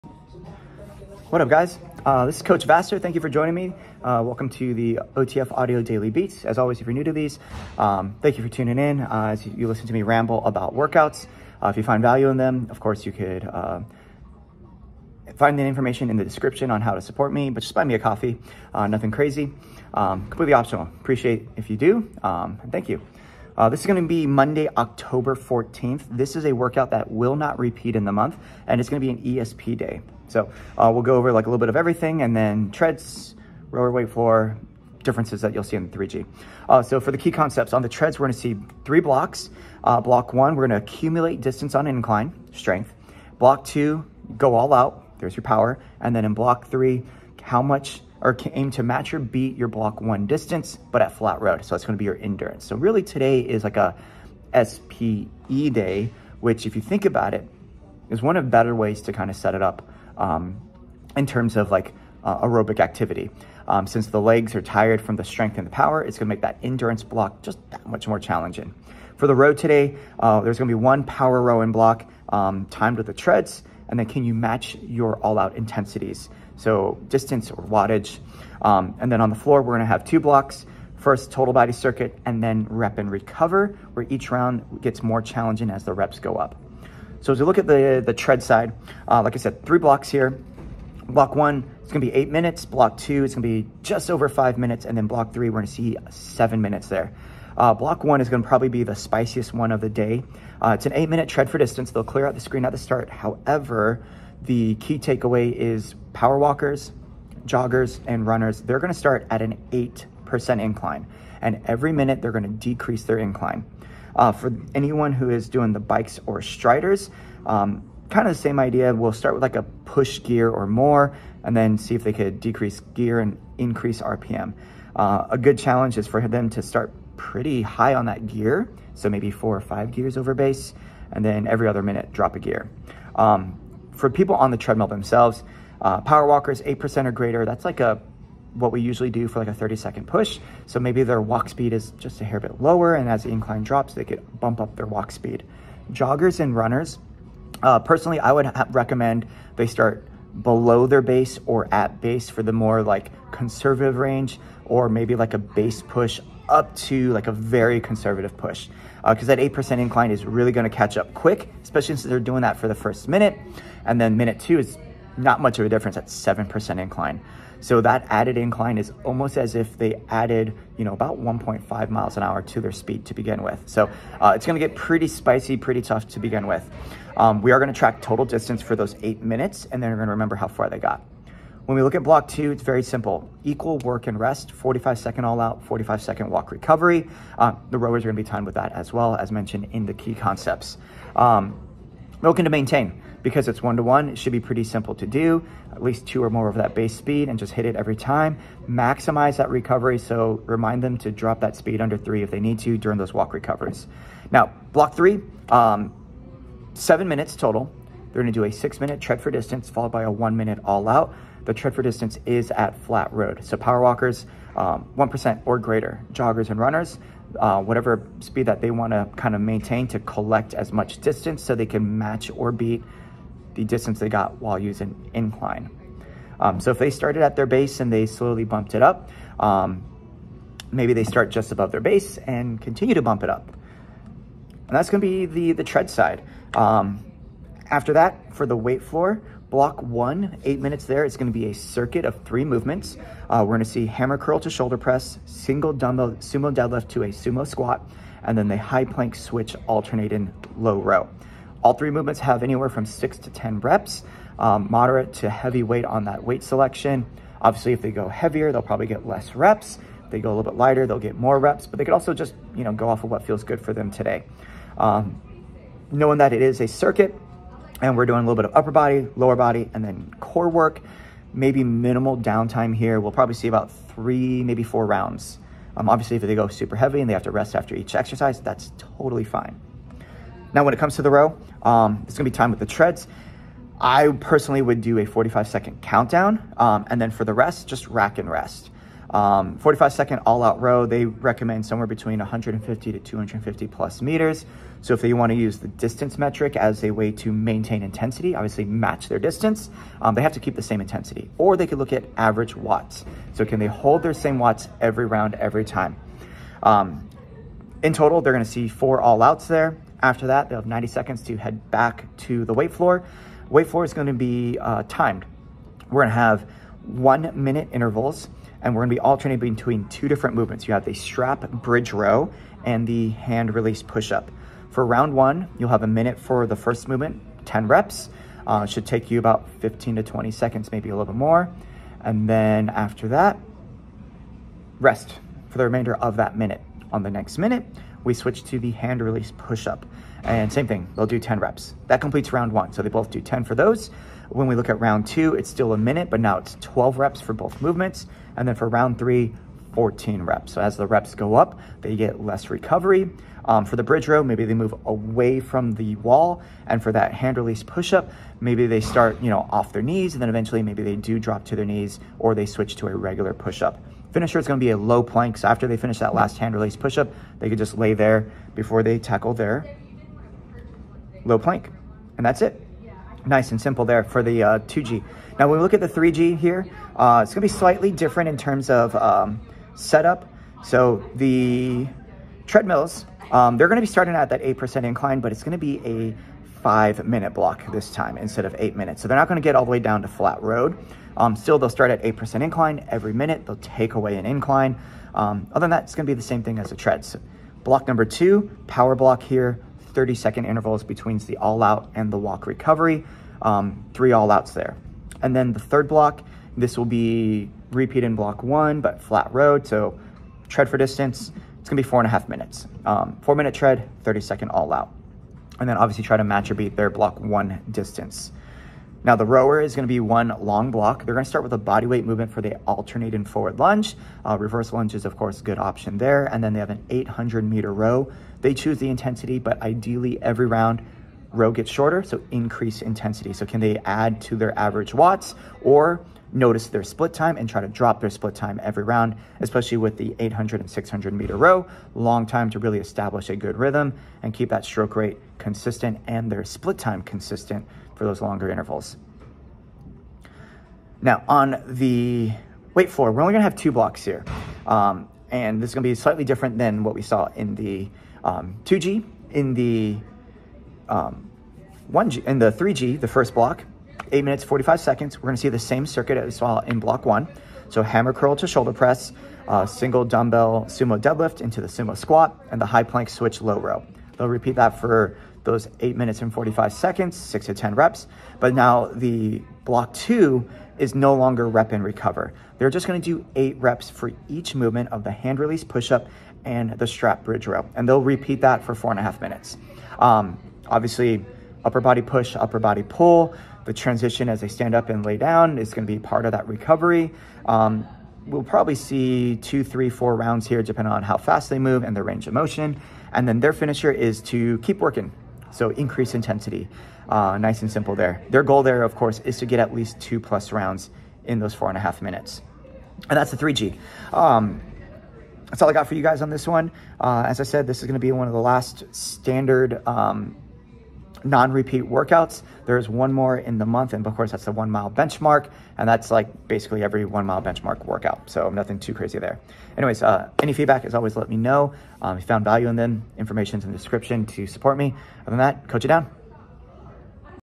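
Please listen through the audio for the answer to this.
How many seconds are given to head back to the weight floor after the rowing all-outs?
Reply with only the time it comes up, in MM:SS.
05:10.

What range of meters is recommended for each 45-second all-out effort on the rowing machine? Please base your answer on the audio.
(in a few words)
150 to 250 plus meters.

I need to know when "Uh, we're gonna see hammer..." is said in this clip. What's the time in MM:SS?
04:03.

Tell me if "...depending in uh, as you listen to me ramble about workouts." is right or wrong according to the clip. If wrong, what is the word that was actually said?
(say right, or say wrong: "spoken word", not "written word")
wrong: "tuning", not "depending".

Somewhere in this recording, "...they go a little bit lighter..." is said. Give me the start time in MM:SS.
04:20.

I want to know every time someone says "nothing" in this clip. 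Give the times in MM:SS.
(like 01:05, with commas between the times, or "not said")
00:18, 08:48.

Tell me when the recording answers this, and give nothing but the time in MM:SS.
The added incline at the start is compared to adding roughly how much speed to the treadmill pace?
02:51.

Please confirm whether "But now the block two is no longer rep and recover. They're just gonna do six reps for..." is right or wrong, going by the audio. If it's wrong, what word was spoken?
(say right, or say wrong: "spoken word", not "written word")
wrong: "eight", not "six".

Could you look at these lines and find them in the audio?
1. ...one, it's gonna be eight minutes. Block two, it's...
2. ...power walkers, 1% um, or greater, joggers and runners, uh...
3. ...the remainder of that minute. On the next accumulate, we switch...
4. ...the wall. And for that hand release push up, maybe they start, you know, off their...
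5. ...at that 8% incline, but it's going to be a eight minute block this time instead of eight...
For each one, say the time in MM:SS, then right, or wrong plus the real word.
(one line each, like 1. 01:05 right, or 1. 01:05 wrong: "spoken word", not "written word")
1. 01:31 right
2. 03:33 right
3. 05:35 wrong: "minute", not "accumulate"
4. 05:55 right
5. 06:24 wrong: "five", not "eight".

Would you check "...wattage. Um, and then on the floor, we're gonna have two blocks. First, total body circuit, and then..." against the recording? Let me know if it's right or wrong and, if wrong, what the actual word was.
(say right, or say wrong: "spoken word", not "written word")
right.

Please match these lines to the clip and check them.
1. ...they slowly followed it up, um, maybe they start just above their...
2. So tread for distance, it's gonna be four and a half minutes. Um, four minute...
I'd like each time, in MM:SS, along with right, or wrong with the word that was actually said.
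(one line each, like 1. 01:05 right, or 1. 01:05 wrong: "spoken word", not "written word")
1. 03:47 wrong: "bumped", not "followed"
2. 06:49 right.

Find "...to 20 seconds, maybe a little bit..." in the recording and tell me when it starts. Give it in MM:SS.
05:29.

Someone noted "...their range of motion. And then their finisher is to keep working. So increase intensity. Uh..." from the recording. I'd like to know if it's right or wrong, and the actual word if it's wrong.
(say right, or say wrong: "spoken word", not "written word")
right.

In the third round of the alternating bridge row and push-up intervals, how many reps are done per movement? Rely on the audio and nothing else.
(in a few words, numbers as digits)
14.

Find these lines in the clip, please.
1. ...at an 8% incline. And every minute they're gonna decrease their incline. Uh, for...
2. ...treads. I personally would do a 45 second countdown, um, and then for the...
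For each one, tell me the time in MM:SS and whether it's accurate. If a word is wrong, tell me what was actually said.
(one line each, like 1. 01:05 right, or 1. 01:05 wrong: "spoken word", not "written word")
1. 01:49 right
2. 04:42 right.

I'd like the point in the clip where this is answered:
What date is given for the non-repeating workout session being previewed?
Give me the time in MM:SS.
00:24.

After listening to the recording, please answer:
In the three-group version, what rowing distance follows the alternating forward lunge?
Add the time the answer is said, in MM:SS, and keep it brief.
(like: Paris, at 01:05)
800 meters, at 07:06.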